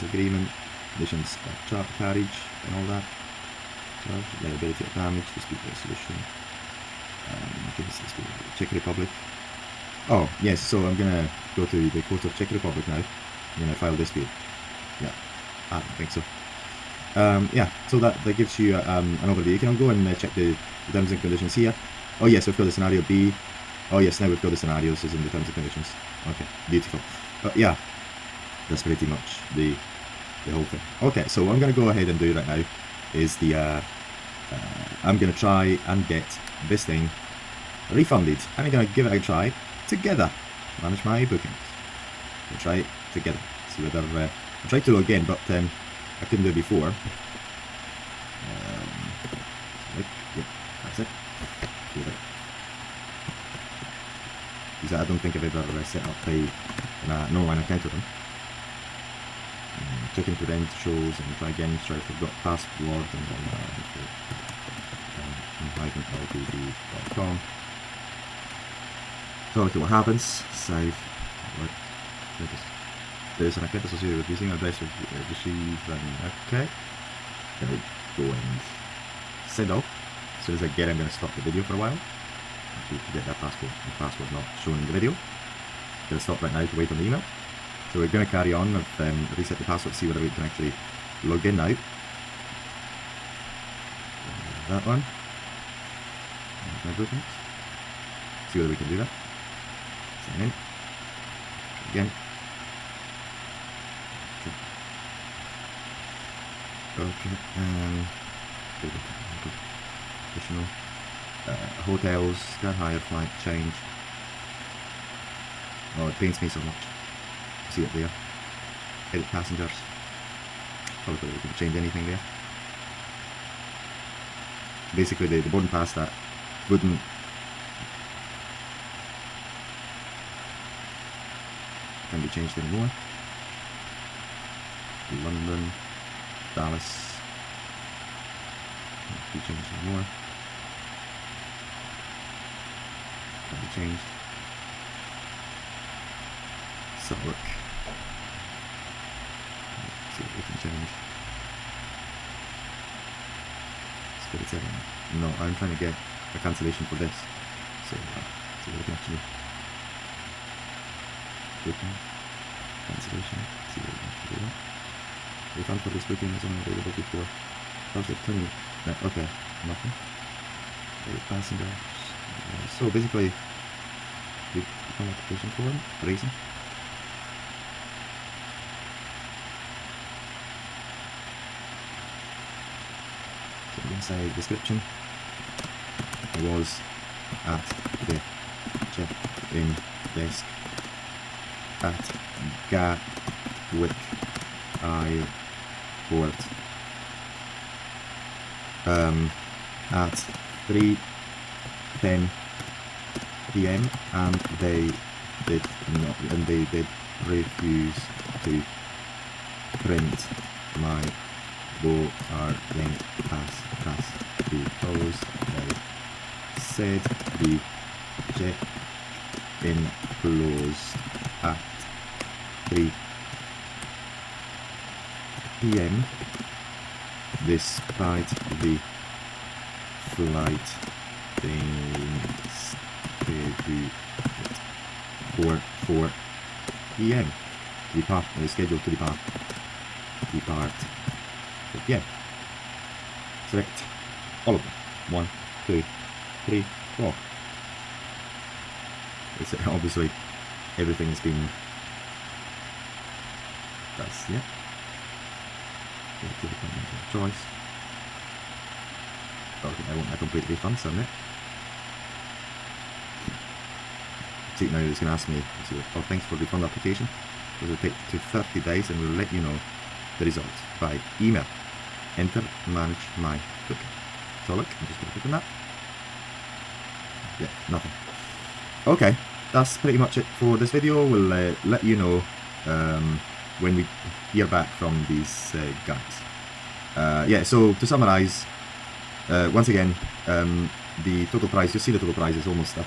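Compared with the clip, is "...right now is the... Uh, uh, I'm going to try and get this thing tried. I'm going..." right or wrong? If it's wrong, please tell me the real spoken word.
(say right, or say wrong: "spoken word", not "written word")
wrong: "refunded", not "tried".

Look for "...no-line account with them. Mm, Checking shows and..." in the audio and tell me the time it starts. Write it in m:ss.
0:57.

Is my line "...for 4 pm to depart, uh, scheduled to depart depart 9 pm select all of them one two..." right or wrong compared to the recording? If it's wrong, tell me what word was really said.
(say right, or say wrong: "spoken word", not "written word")
wrong: "4", not "9".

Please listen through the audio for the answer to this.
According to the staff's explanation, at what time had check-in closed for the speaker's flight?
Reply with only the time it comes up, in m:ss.
3:42.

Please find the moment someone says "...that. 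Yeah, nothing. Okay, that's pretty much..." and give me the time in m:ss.
4:35.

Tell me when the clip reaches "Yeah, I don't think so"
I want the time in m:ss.
0:15.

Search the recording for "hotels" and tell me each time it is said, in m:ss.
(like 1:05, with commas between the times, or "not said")
1:51.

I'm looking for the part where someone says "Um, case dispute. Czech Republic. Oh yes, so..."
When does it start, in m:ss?
0:07.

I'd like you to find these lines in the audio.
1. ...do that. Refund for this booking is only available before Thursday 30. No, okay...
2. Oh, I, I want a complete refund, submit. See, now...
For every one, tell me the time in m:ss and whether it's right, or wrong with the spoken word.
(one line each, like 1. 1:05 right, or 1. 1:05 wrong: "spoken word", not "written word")
1. 2:44 wrong: "20", not "30"
2. 4:19 right.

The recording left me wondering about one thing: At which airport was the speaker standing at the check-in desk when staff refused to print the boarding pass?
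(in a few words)
Gatwick Airport.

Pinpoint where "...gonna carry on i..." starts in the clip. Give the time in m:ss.
1:28.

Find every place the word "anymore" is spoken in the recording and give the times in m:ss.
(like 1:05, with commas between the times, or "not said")
2:12, 2:19.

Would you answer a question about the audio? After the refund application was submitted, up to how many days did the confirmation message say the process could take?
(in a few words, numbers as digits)
30 days.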